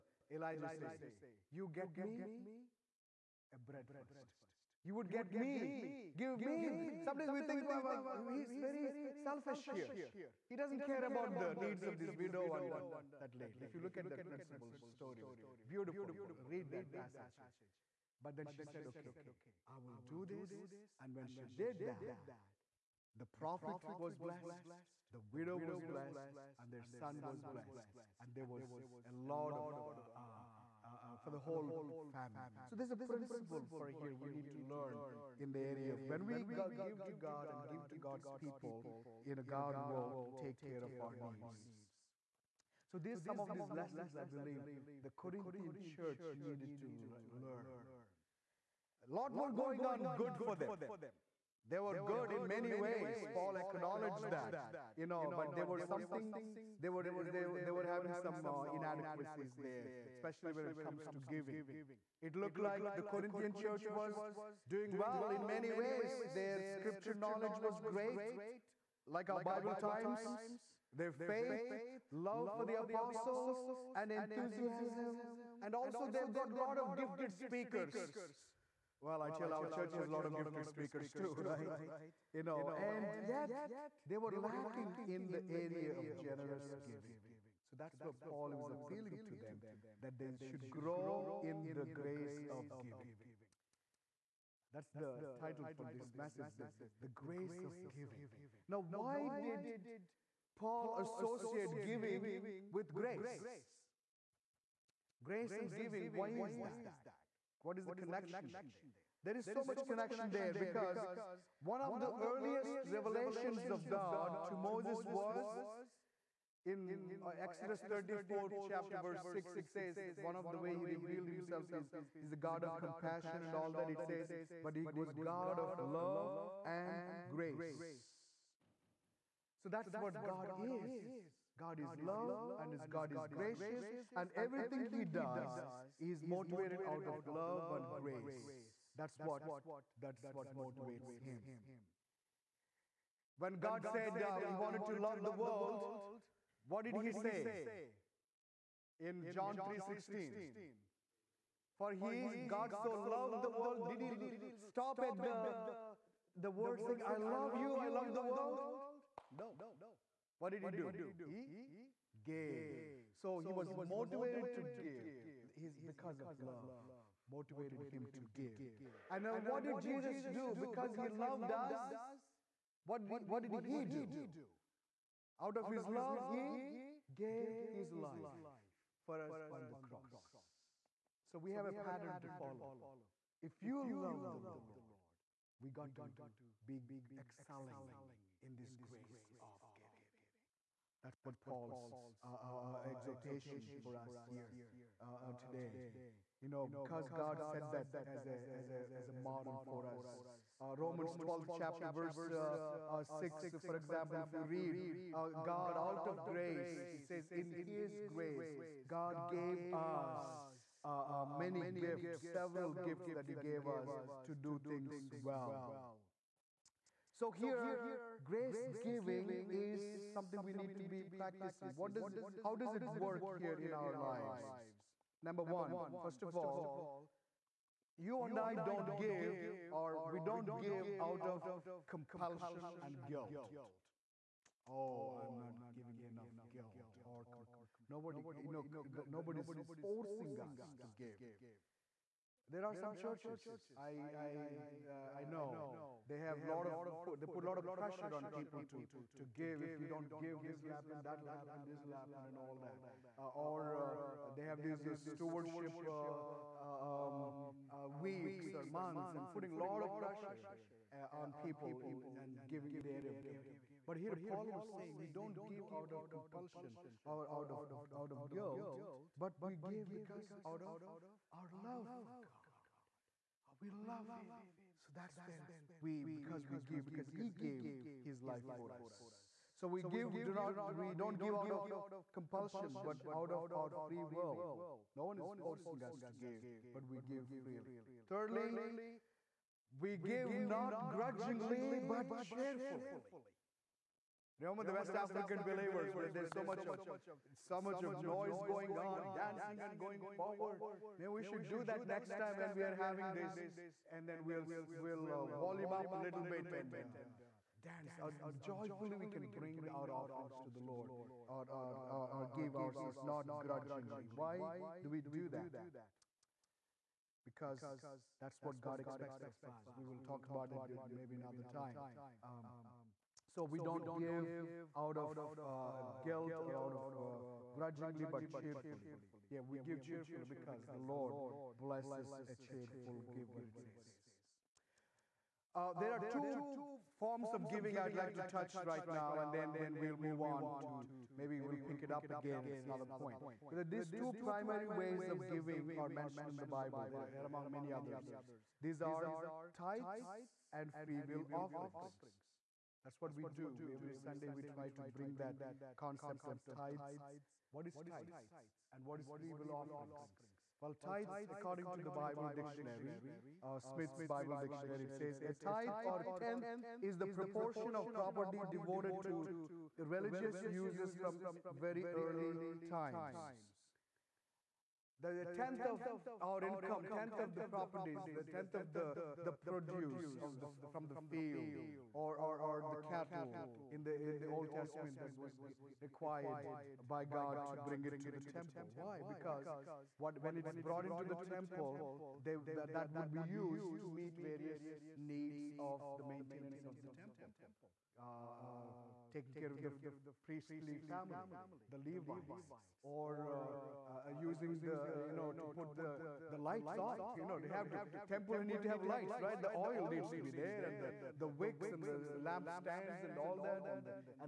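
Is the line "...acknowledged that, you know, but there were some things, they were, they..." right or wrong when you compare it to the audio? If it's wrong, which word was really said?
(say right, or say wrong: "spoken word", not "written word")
right.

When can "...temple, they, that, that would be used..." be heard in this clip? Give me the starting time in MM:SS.
06:31.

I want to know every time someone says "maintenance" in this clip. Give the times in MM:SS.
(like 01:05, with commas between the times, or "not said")
06:36.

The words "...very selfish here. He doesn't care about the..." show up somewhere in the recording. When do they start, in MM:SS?
00:08.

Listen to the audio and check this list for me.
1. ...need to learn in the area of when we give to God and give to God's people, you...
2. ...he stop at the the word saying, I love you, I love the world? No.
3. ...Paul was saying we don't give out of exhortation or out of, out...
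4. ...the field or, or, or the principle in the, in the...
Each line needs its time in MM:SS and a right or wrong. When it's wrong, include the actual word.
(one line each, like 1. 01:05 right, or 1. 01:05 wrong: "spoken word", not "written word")
1. 00:34 right
2. 02:33 right
3. 04:24 wrong: "compulsion", not "exhortation"
4. 06:20 wrong: "cattle", not "principle".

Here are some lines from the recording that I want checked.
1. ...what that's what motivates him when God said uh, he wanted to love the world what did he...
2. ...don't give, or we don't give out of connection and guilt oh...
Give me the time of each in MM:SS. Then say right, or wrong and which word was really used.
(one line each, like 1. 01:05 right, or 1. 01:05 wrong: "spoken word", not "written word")
1. 02:19 right
2. 03:48 wrong: "compulsion", not "connection".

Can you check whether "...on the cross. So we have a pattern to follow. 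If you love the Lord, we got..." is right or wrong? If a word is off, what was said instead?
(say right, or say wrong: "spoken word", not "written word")
right.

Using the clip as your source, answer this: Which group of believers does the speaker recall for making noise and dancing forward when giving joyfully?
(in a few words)
West African believers.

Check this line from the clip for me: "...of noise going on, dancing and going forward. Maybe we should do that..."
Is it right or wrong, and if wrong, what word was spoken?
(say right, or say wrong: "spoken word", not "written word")
right.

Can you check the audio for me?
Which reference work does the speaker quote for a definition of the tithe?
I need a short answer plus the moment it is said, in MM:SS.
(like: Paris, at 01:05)
Smith's Bible dictionary, at 06:03.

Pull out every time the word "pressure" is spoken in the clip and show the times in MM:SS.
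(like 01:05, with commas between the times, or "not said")
04:07, 04:19.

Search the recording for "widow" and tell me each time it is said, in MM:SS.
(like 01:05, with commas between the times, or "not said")
00:12, 00:25.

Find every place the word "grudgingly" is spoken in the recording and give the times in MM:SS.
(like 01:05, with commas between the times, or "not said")
04:50, 05:13, 05:27.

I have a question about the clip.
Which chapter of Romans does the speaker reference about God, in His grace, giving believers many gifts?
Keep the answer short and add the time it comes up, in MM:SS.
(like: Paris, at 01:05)
Romans 12, at 03:20.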